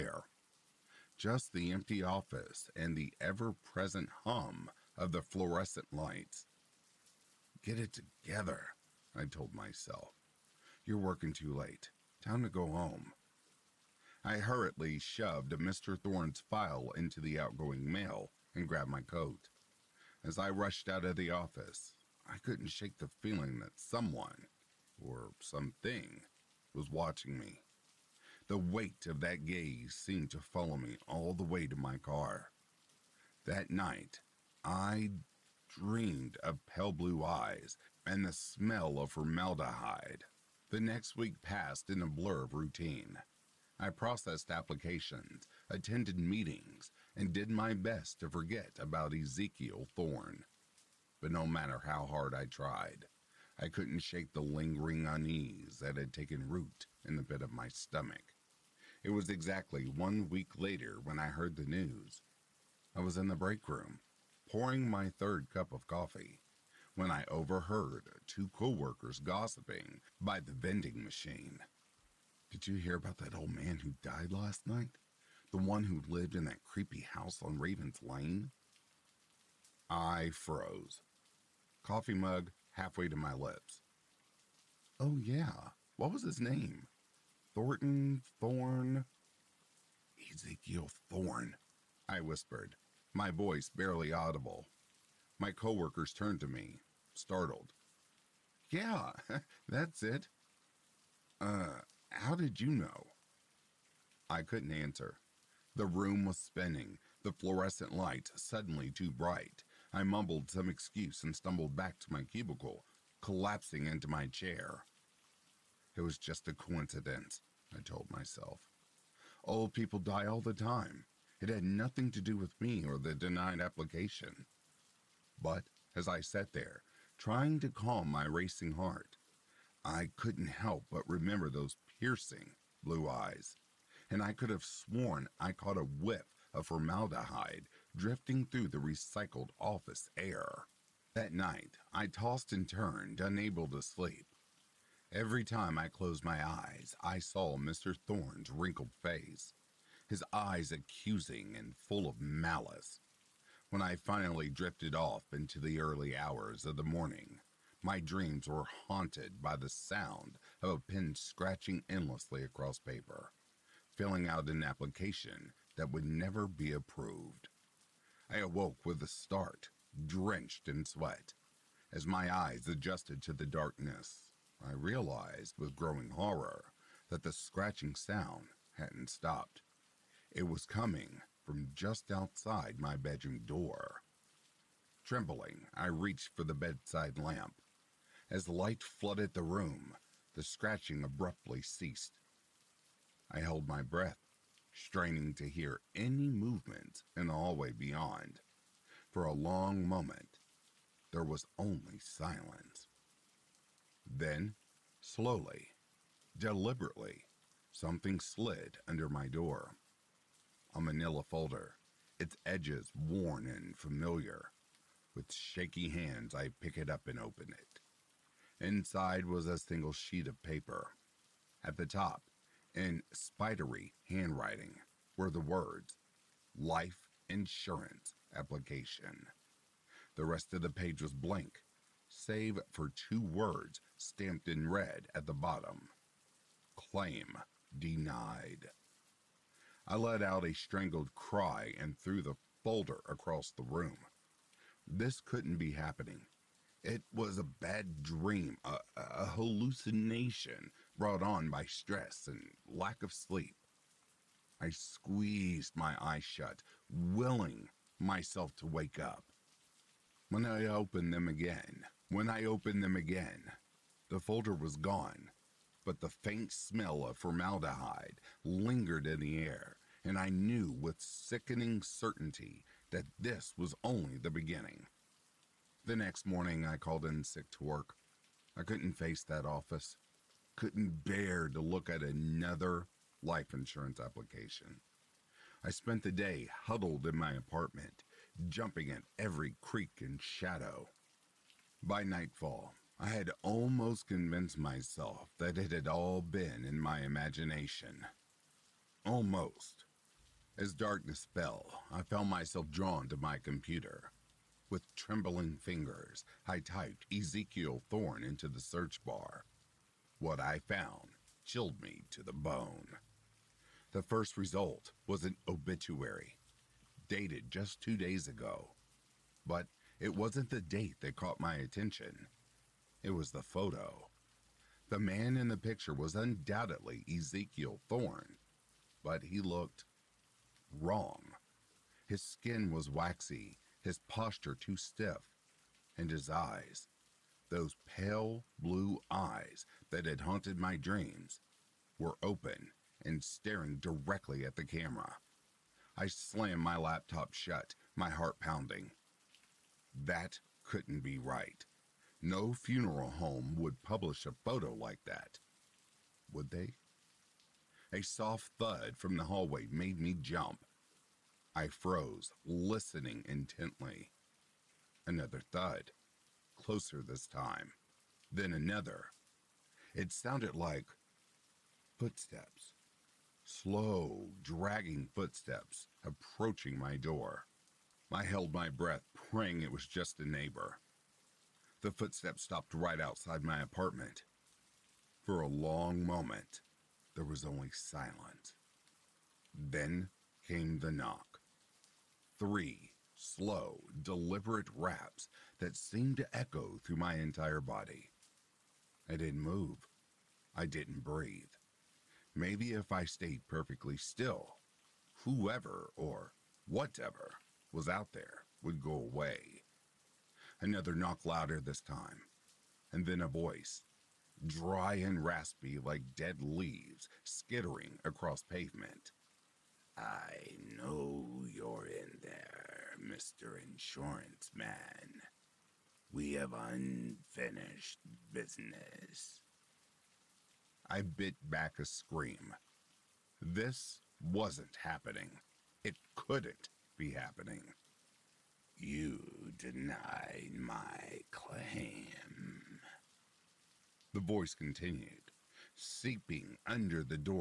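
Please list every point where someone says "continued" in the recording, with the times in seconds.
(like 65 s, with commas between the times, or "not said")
444 s.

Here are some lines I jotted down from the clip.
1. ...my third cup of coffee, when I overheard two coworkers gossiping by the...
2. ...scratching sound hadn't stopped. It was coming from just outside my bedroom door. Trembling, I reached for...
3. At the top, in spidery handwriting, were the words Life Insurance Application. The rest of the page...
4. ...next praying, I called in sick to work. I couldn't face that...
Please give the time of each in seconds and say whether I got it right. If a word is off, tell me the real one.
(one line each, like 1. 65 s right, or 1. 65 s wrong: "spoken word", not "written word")
1. 64 s right
2. 177 s right
3. 221 s right
4. 275 s wrong: "morning", not "praying".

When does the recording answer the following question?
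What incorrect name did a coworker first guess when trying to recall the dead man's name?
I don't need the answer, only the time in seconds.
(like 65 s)
87 s.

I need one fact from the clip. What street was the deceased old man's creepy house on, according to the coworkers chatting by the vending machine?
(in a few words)
Raven's Lane.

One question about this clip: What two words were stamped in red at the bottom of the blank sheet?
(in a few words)
Claim Denied.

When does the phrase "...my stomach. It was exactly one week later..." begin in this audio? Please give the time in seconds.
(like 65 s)
57 s.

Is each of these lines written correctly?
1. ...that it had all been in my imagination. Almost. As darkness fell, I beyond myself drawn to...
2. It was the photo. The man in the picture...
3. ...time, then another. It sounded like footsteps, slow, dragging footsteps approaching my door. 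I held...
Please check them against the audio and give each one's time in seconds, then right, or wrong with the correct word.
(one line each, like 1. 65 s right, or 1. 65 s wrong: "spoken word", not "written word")
1. 295 s wrong: "found", not "beyond"
2. 323 s right
3. 367 s right.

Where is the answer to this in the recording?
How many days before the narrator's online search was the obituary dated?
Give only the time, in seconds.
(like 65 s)
317 s.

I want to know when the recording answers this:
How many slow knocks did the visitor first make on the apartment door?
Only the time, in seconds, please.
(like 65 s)
392 s.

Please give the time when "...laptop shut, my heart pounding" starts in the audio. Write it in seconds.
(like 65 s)
346 s.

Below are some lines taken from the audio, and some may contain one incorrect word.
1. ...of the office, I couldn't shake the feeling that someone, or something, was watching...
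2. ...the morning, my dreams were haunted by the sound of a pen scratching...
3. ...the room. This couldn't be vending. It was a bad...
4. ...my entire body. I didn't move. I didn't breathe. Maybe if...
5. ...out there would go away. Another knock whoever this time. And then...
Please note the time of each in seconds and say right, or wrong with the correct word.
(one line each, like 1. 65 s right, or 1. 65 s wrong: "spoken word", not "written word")
1. 21 s right
2. 156 s right
3. 243 s wrong: "happening", not "vending"
4. 396 s right
5. 407 s wrong: "louder", not "whoever".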